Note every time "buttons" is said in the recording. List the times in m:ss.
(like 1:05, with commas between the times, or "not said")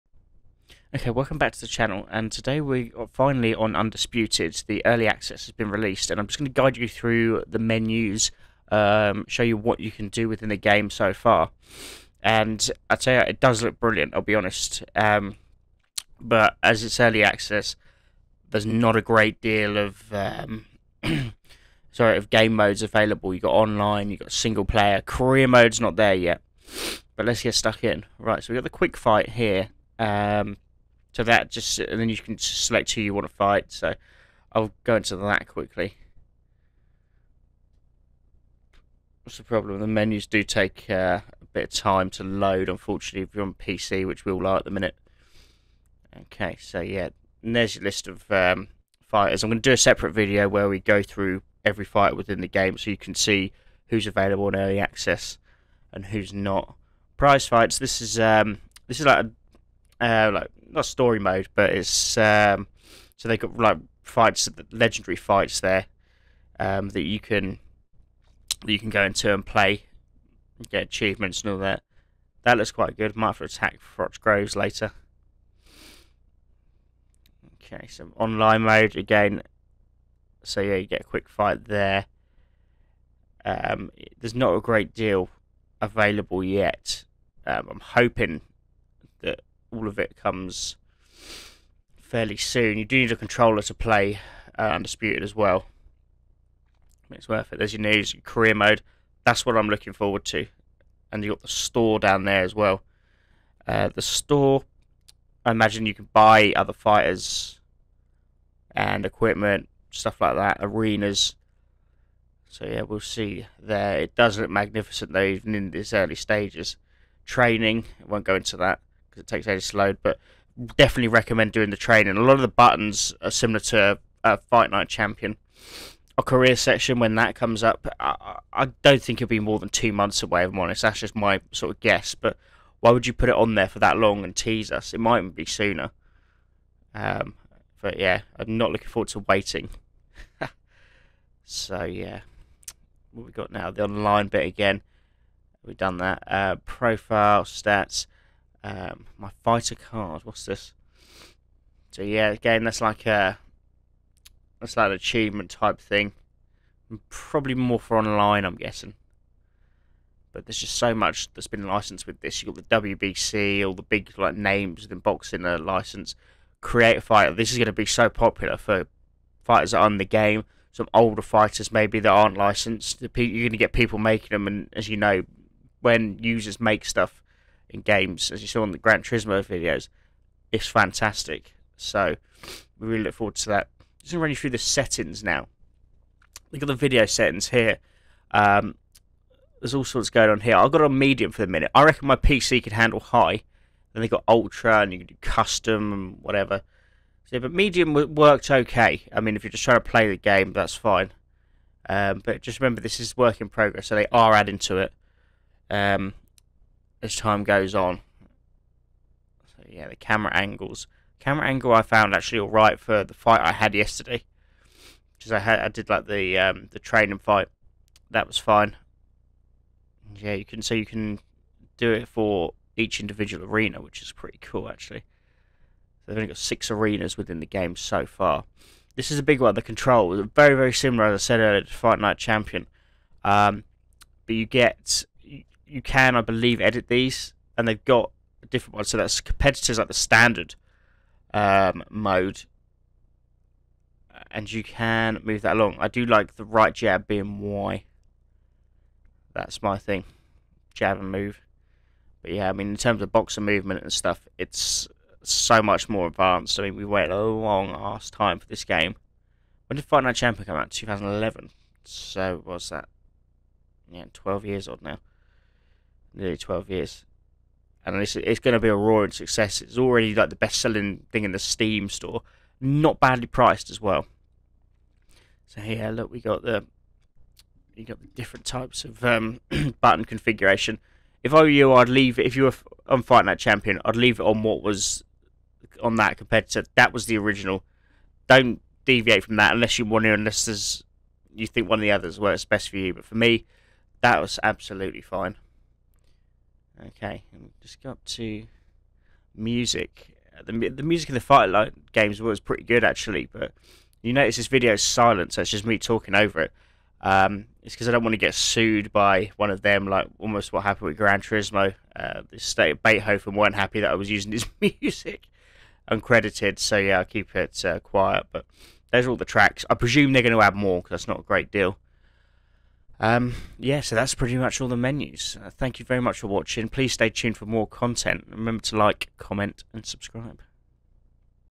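2:02, 4:39.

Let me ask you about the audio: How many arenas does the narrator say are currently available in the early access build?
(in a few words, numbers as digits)
6.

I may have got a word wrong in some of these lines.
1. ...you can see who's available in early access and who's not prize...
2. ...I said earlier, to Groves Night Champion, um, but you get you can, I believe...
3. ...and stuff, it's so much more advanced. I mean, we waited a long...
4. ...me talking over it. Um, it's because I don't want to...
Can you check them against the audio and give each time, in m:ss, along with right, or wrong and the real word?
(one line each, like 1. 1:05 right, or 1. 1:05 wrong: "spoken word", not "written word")
1. 0:52 right
2. 3:51 wrong: "Fight", not "Groves"
3. 4:13 right
4. 5:05 right.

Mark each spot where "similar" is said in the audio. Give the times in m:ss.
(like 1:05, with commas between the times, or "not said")
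2:03, 3:50.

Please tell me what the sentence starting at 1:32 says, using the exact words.
You do need a controller to play uh, Undisputed as well.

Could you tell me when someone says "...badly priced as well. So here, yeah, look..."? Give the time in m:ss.
4:32.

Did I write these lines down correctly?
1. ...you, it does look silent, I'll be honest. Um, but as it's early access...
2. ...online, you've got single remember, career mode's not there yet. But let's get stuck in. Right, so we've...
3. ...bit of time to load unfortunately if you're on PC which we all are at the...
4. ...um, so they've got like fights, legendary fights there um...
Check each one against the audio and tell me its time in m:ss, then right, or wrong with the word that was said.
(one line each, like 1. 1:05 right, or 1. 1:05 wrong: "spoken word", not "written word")
1. 0:13 wrong: "brilliant", not "silent"
2. 0:23 wrong: "player", not "remember"
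3. 0:41 right
4. 1:02 right.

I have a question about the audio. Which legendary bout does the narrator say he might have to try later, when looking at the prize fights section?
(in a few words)
Froch Groves.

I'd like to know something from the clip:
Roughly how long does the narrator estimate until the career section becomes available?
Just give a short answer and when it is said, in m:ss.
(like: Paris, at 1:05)
2 months, at 2:09.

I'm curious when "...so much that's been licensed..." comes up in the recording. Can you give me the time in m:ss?
2:40.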